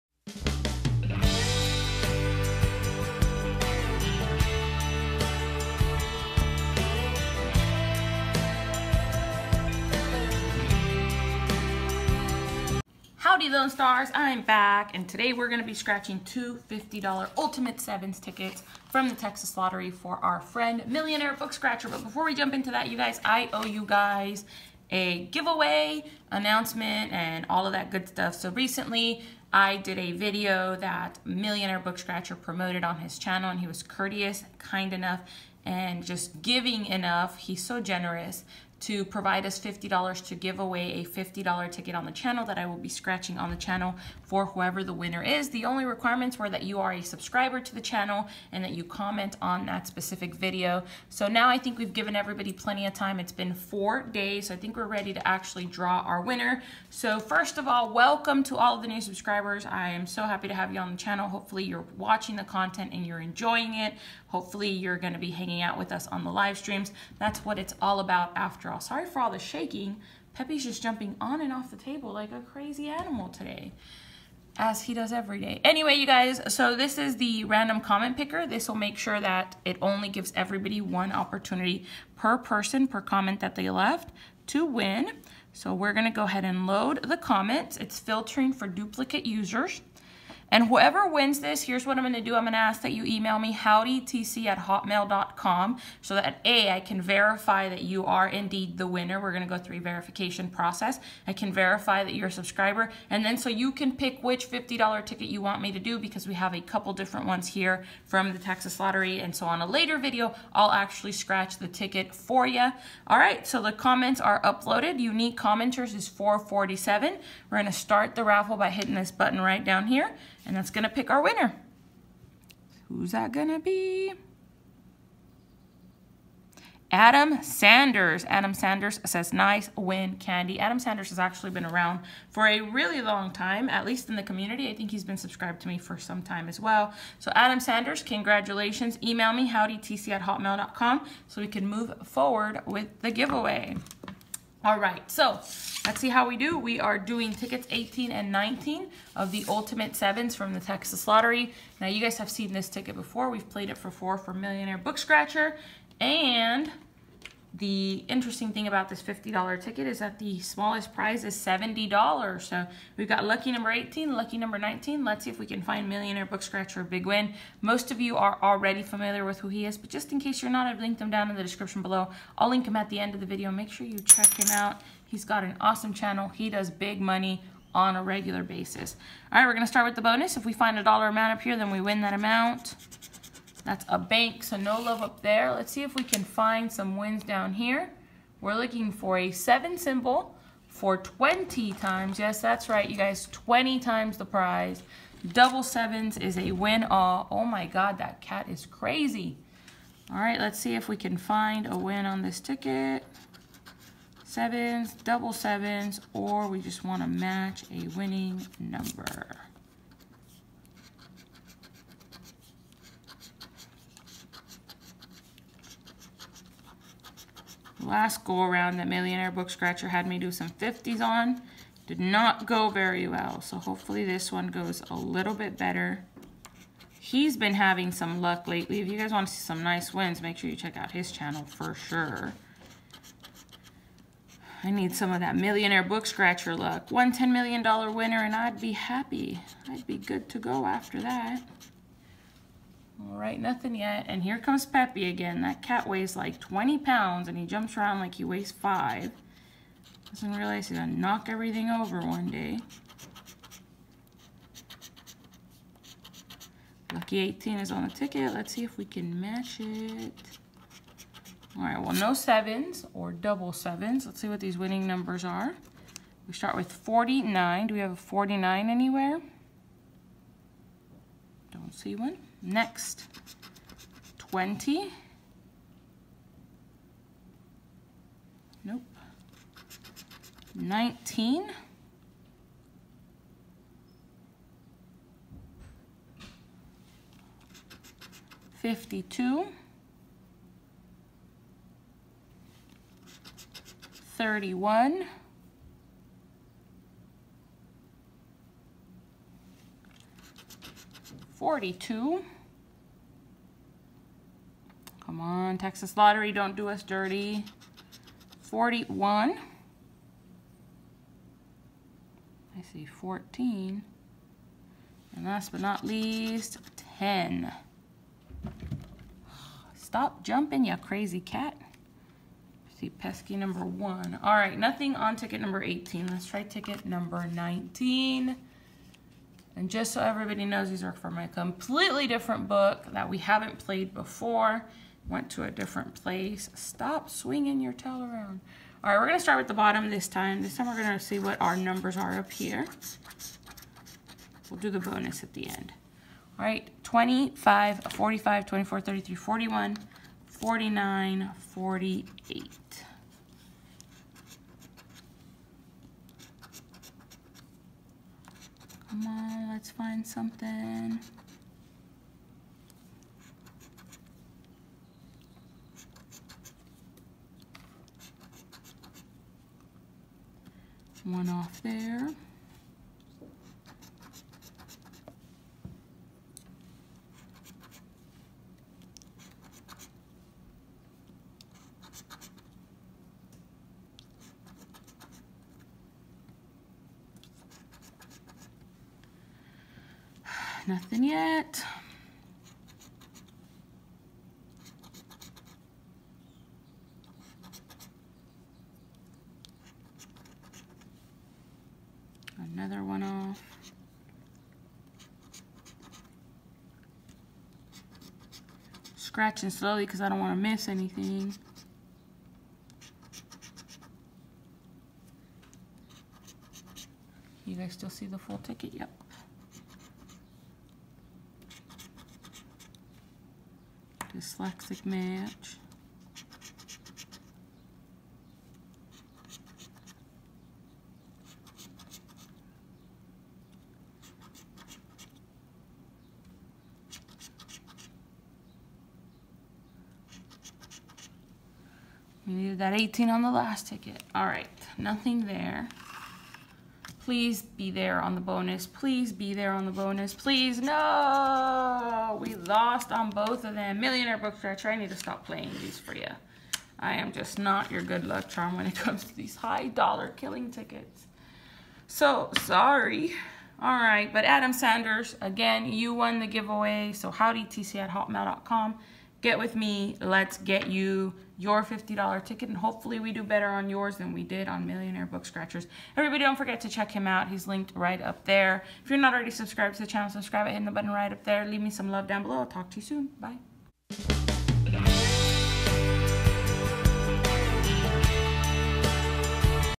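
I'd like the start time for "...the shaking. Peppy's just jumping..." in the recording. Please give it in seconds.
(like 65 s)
69 s.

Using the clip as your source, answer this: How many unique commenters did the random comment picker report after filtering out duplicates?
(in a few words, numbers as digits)
447.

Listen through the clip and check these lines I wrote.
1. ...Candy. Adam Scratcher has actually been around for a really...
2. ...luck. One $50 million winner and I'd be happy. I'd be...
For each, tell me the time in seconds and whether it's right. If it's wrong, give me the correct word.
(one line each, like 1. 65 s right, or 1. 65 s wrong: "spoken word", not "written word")
1. 130 s wrong: "Sanders", not "Scratcher"
2. 236 s wrong: "10", not "50".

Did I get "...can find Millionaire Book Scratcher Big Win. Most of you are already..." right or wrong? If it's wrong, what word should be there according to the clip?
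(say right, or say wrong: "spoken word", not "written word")
right.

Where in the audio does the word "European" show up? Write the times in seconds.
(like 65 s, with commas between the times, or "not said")
not said.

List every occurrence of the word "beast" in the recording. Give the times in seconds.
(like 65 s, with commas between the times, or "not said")
not said.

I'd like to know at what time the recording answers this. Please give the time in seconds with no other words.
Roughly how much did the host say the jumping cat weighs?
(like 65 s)
246 s.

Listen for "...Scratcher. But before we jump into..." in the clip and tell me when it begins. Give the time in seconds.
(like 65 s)
21 s.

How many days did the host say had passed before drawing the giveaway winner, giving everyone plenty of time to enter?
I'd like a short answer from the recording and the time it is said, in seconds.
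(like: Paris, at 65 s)
4, at 53 s.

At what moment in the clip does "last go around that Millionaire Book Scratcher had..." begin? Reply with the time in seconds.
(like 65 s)
217 s.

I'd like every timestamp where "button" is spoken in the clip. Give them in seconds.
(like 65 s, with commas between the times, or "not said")
119 s, 480 s.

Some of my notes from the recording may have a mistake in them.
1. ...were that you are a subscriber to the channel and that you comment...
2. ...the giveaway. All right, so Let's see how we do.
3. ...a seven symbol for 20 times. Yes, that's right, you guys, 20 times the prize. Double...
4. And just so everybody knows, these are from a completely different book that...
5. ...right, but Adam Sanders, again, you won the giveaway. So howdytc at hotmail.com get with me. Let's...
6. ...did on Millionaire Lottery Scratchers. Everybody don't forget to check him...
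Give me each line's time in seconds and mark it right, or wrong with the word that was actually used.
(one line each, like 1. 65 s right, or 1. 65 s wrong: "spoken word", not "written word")
1. 46 s right
2. 142 s right
3. 189 s right
4. 329 s right
5. 463 s right
6. 474 s wrong: "Book", not "Lottery".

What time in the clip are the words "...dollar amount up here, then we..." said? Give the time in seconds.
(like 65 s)
180 s.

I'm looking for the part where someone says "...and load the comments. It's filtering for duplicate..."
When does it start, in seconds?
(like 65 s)
86 s.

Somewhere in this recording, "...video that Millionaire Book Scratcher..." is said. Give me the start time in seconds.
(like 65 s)
30 s.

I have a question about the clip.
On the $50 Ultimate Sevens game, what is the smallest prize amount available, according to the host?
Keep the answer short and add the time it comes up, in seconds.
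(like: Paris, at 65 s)
$70, at 161 s.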